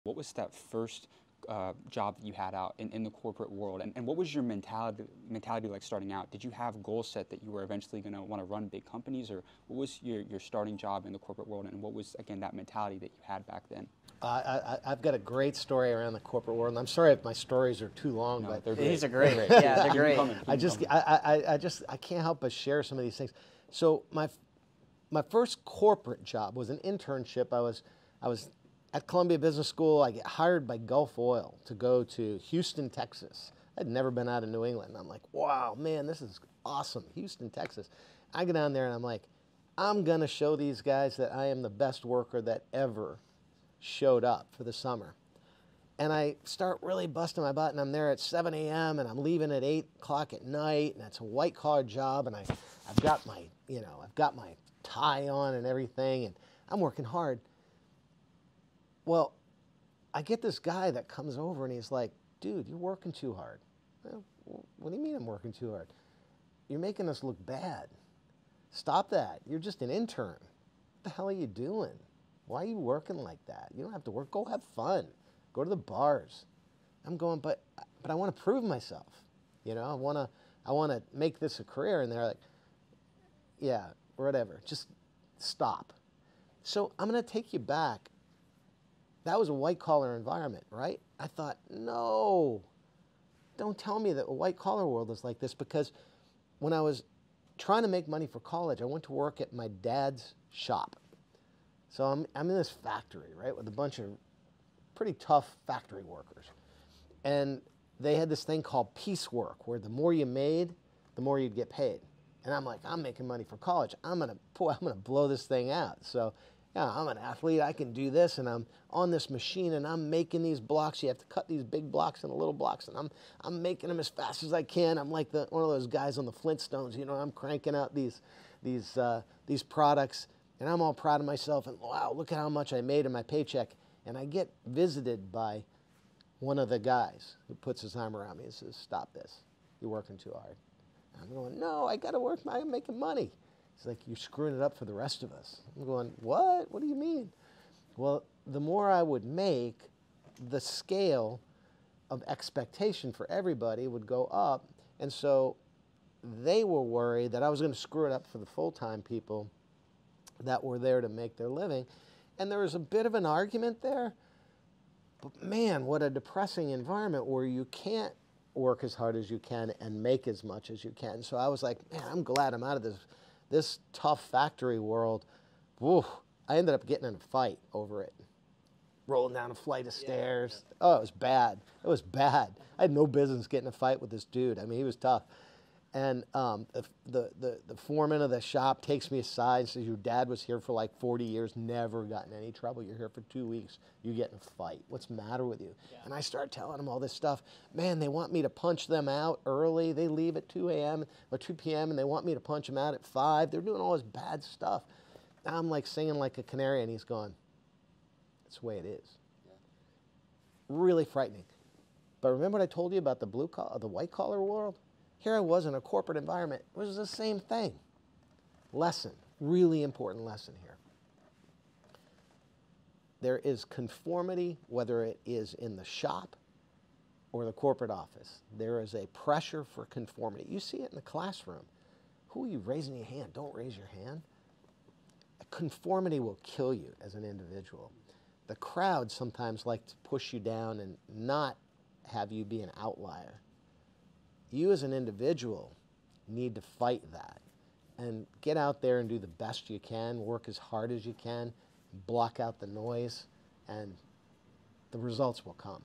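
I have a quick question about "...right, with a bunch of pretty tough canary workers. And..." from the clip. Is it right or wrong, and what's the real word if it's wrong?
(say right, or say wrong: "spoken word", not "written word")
wrong: "factory", not "canary".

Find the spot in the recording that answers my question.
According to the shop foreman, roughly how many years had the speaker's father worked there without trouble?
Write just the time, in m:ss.
3:11.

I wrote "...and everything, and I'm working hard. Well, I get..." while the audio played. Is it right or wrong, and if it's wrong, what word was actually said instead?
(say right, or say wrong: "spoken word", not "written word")
right.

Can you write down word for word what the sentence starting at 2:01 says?
You have to cut these big blocks into little blocks, and I'm, I'm making them as fast as I can.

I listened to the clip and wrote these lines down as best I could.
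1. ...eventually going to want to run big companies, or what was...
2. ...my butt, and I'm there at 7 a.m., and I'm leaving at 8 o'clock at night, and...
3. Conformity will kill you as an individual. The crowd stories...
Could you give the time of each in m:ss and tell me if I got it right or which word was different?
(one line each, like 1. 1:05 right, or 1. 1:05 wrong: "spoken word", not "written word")
1. 0:07 right
2. 0:47 right
3. 3:55 wrong: "sometimes", not "stories".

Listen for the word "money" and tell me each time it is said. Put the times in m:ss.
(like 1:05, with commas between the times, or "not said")
1:38, 1:53, 2:22.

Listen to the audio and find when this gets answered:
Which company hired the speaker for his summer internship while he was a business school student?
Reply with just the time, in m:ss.
0:30.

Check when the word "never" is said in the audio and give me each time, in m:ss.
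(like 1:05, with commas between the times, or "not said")
0:33, 3:11.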